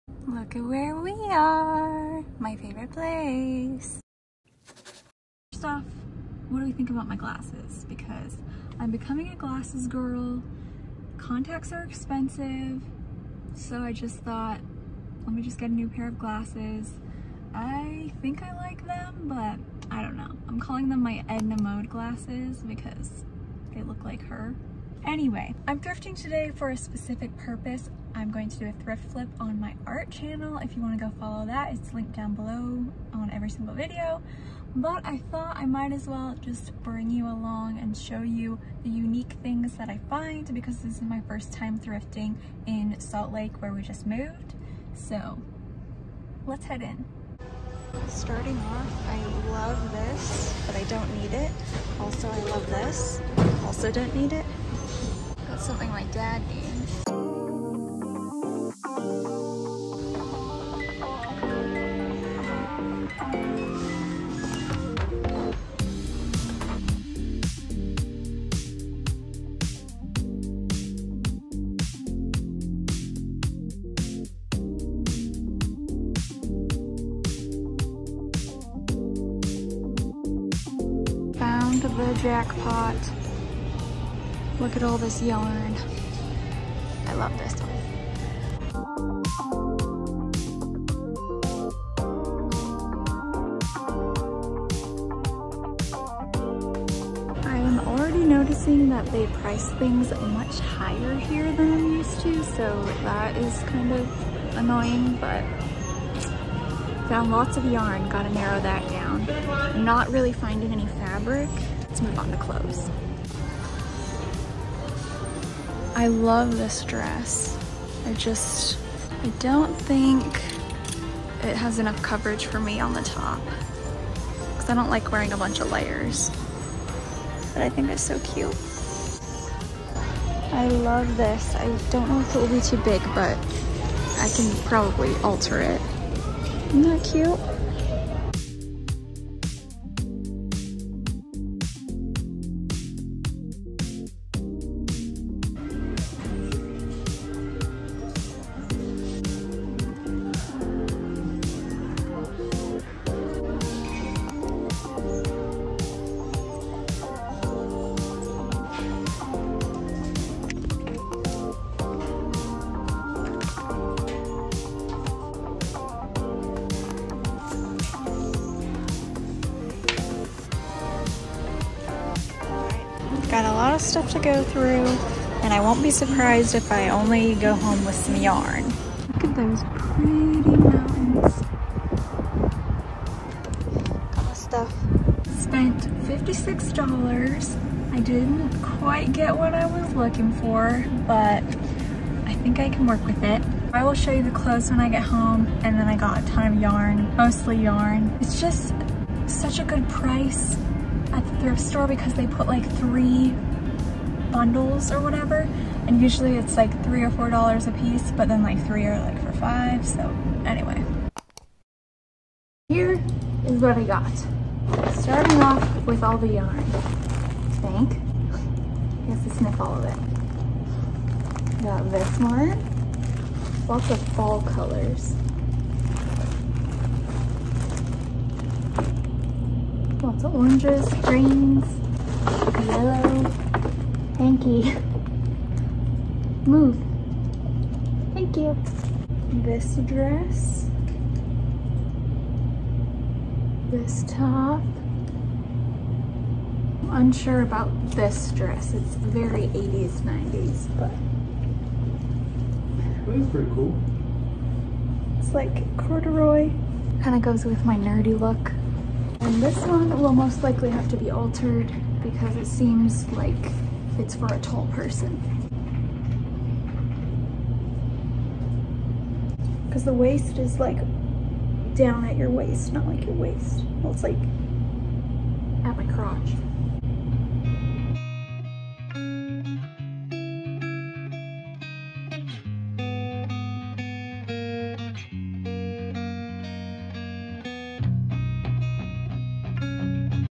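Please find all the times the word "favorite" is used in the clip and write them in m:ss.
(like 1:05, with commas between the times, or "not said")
0:02.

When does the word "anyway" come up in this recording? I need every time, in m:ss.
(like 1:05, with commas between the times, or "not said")
0:25, 3:30.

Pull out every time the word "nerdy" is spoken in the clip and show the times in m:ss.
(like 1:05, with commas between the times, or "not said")
4:17.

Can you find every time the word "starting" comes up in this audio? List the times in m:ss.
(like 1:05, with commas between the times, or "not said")
0:48, 3:34.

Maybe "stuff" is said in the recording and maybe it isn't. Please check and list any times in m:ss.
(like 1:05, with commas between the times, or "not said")
2:53, 3:04.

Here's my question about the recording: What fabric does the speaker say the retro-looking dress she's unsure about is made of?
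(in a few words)
corduroy.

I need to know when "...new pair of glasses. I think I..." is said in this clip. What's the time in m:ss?
0:15.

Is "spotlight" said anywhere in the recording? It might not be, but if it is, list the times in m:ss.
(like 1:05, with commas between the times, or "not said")
not said.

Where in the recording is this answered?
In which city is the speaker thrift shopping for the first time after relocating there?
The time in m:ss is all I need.
0:42.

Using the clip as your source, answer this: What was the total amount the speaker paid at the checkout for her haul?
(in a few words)
$56.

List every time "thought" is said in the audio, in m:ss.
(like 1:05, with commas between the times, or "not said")
0:14, 0:35.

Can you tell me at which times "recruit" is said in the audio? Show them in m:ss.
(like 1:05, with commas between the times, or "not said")
not said.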